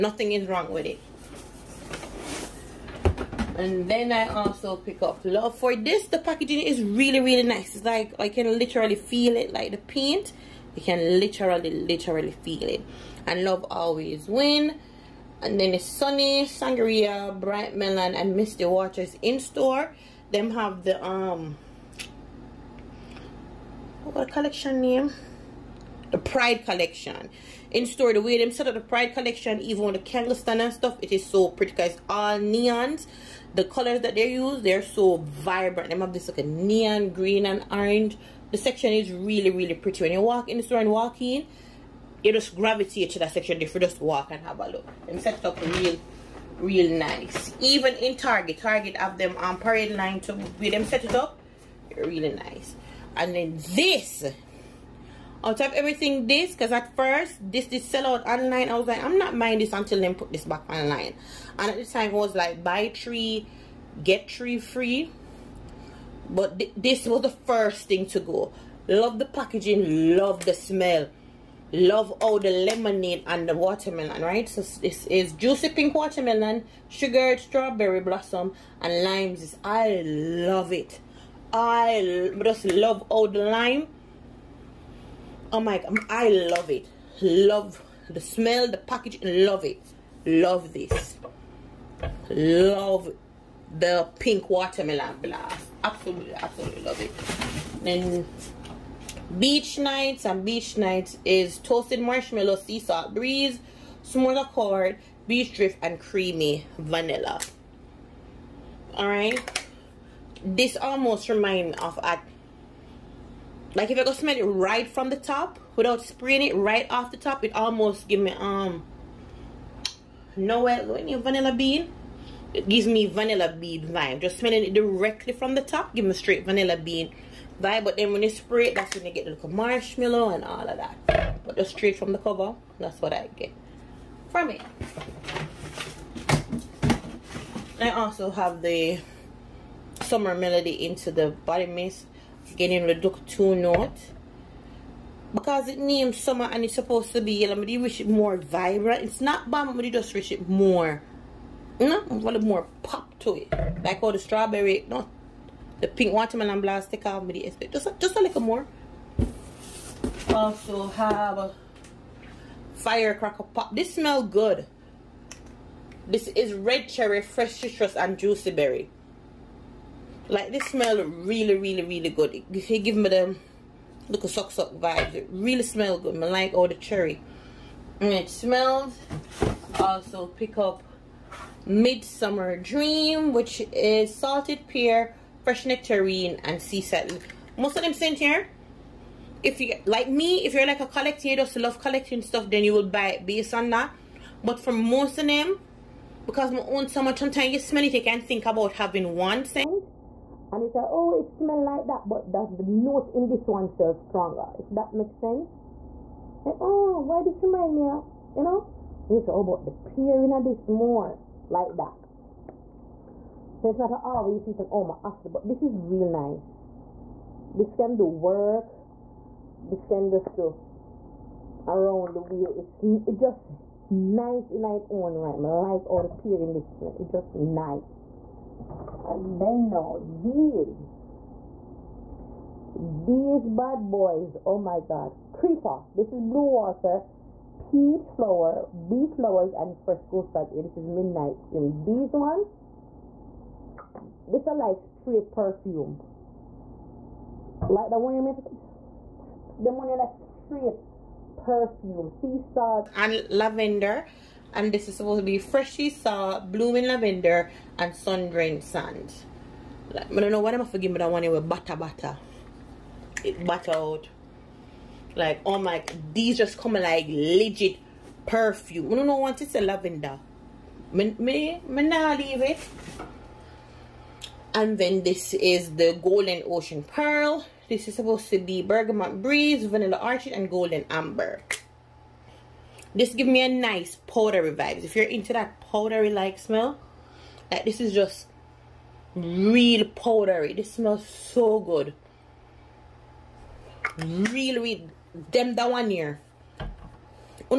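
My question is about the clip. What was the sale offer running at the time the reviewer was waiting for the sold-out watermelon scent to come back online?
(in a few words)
Buy three, get three free.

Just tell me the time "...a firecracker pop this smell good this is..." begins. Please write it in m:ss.
2:41.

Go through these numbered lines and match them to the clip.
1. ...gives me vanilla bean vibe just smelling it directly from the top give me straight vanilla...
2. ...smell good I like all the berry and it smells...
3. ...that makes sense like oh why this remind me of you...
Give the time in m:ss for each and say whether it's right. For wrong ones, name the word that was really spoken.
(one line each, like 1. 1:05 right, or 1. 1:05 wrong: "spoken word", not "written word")
1. 2:02 right
2. 2:55 wrong: "cherry", not "berry"
3. 3:24 right.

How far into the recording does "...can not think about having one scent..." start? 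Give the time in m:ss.
3:18.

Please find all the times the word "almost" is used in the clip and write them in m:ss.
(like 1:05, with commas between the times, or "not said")
1:50, 1:57.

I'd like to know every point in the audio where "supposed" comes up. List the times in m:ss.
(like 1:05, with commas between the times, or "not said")
2:26, 4:14, 4:37.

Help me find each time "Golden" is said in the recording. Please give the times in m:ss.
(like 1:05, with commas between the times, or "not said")
4:36, 4:40.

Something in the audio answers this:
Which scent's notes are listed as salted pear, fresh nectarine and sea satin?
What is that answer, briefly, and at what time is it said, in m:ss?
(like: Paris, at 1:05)
Midsummer Dream, at 3:01.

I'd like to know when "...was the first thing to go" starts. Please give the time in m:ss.
1:07.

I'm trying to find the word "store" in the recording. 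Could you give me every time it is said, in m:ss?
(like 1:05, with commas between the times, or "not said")
0:19, 0:27, 0:40.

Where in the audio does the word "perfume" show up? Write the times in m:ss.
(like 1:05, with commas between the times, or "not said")
4:05, 4:11, 4:28.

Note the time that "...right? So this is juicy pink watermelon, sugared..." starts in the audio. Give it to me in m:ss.
1:14.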